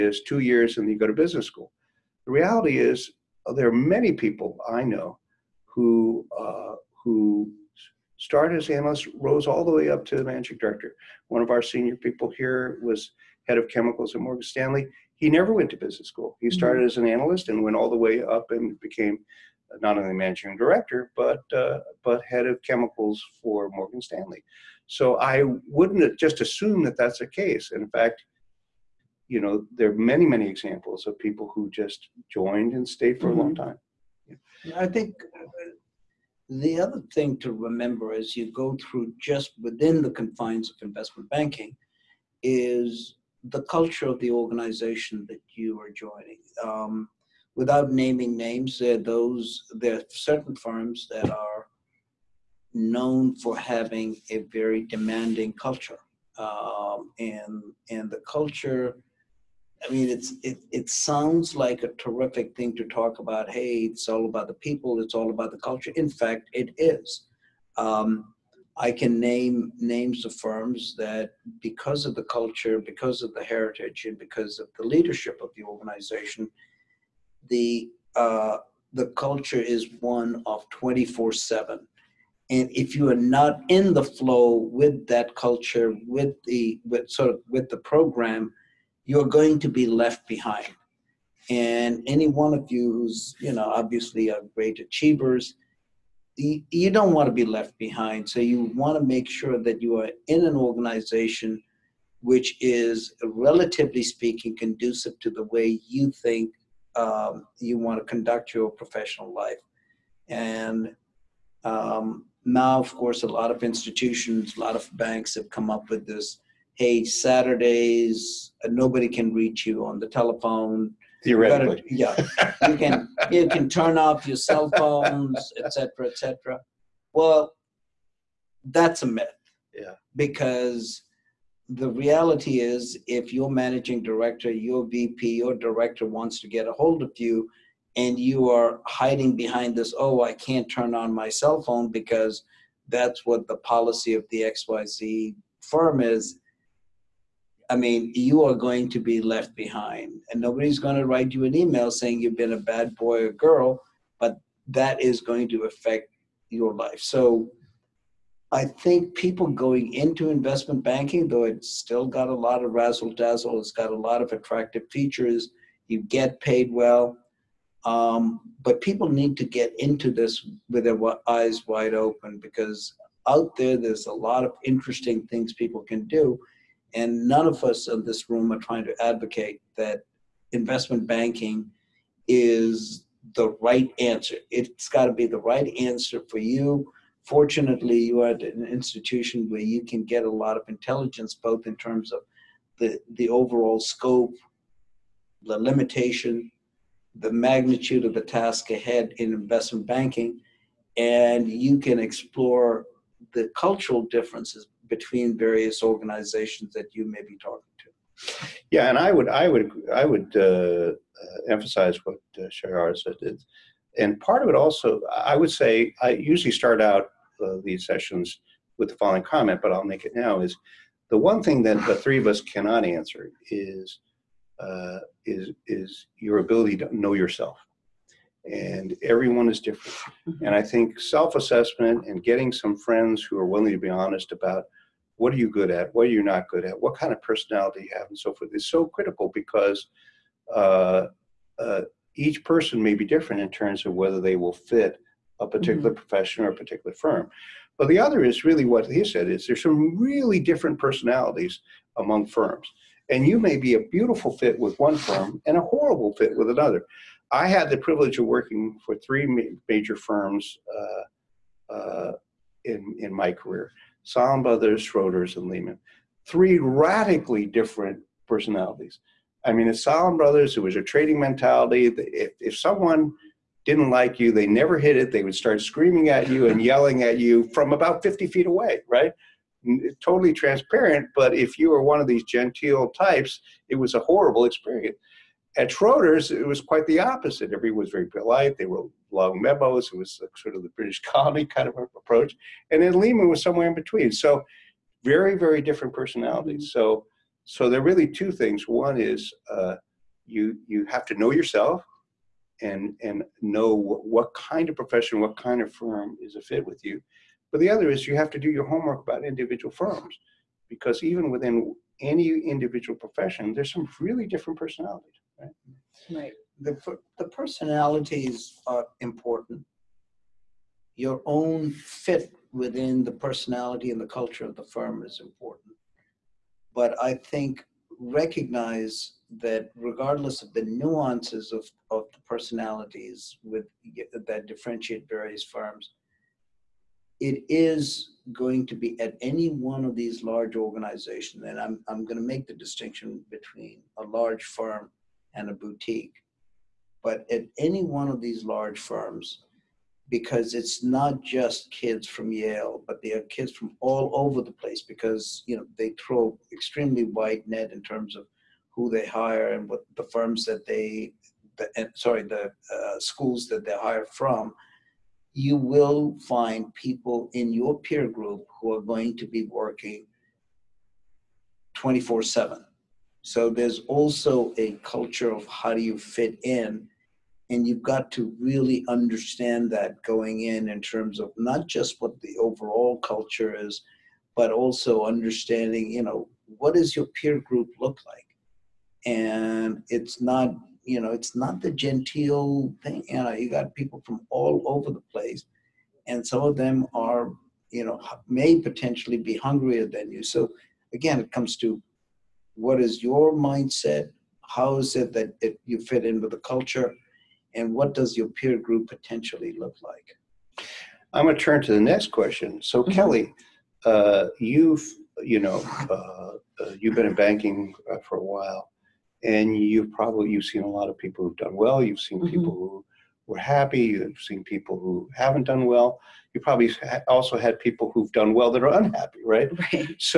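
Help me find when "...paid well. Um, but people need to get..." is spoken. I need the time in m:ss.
2:46.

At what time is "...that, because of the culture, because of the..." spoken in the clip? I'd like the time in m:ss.
1:10.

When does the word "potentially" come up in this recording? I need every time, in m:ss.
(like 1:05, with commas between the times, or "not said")
6:38, 6:48.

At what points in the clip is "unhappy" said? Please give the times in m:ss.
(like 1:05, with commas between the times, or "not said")
7:08.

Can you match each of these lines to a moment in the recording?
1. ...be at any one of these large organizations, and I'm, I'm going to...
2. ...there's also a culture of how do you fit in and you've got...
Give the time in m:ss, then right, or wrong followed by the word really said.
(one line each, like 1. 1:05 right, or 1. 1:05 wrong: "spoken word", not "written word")
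1. 5:38 right
2. 6:13 right.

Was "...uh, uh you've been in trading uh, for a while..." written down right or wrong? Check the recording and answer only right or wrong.
wrong.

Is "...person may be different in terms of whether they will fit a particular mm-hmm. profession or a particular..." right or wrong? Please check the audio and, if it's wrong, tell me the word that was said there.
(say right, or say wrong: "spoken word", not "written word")
right.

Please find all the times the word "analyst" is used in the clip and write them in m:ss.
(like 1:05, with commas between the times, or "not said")
0:08, 0:17.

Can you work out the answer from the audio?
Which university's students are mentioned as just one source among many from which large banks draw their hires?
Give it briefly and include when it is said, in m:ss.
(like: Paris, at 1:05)
Yale, at 5:52.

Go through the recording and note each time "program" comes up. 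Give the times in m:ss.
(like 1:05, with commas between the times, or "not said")
1:27.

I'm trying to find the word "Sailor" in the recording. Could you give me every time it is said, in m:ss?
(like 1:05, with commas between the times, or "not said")
not said.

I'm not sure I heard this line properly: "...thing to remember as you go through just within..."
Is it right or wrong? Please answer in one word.
right.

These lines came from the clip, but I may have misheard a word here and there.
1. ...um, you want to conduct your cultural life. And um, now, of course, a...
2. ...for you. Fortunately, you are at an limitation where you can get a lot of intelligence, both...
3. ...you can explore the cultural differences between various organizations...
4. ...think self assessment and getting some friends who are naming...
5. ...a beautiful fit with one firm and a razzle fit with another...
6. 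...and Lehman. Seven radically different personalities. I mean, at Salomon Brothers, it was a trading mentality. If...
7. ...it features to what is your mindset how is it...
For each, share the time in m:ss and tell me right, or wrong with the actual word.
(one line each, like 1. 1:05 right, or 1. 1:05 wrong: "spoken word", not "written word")
1. 1:46 wrong: "professional", not "cultural"
2. 3:06 wrong: "institution", not "limitation"
3. 3:21 right
4. 3:50 wrong: "willing", not "naming"
5. 4:13 wrong: "horrible", not "razzle"
6. 4:25 wrong: "Three", not "Seven"
7. 6:41 wrong: "comes", not "features".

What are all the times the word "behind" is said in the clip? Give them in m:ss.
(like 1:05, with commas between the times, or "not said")
1:30, 1:37, 2:19, 2:29.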